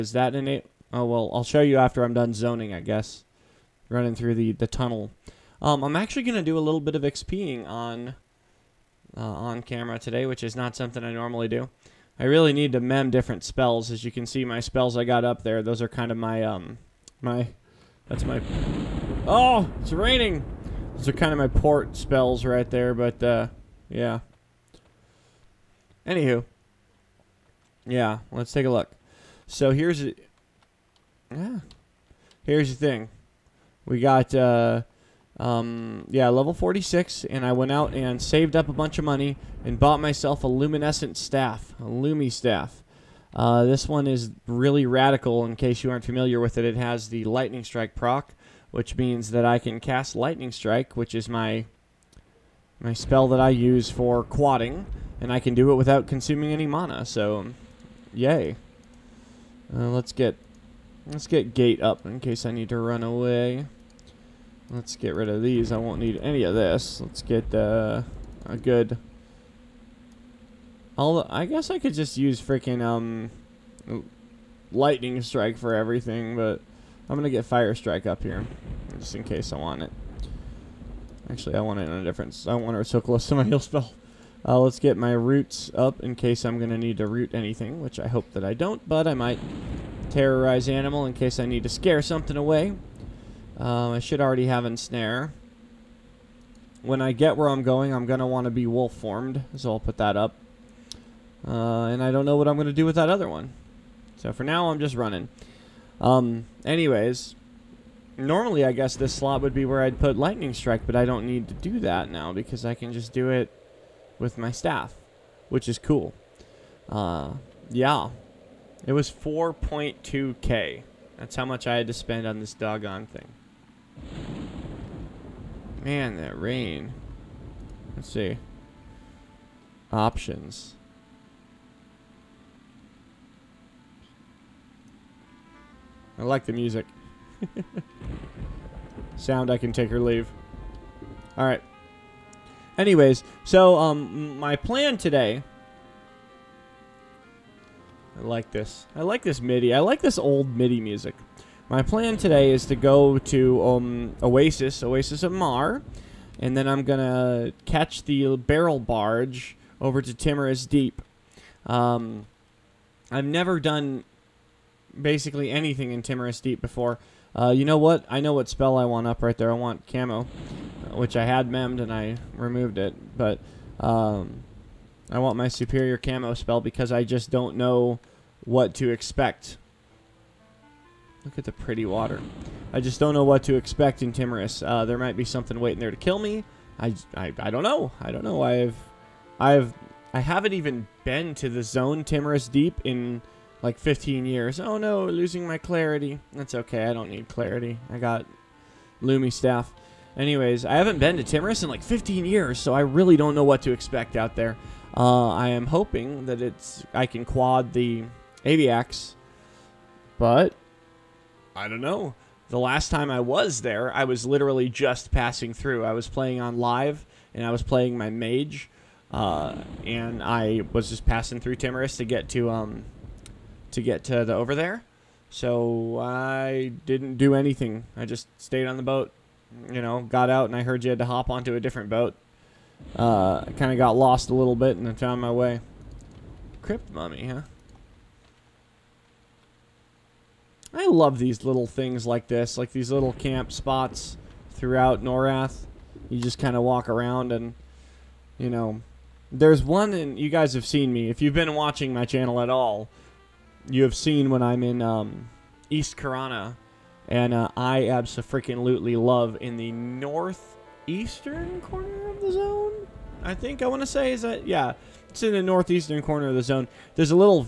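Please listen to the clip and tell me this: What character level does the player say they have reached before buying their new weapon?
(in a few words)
46.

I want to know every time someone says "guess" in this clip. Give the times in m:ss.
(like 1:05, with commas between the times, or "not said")
0:02, 1:11, 1:48.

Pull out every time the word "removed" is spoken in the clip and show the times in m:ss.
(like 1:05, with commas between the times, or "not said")
2:52.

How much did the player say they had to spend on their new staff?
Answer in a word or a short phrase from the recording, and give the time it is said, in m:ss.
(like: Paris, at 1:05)
4.2k, at 1:59.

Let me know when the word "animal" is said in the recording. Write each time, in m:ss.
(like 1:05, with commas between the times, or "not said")
1:30.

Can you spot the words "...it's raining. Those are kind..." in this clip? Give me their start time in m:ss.
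0:19.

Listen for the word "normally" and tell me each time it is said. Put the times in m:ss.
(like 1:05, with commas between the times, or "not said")
0:11, 1:48.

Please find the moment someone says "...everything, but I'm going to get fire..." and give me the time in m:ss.
1:15.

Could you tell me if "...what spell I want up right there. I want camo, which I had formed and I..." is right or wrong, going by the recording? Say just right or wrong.
wrong.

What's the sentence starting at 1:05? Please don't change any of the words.
I won't need any of this.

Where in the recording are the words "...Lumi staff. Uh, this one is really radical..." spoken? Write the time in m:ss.
0:41.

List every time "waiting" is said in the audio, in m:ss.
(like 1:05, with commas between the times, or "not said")
3:05.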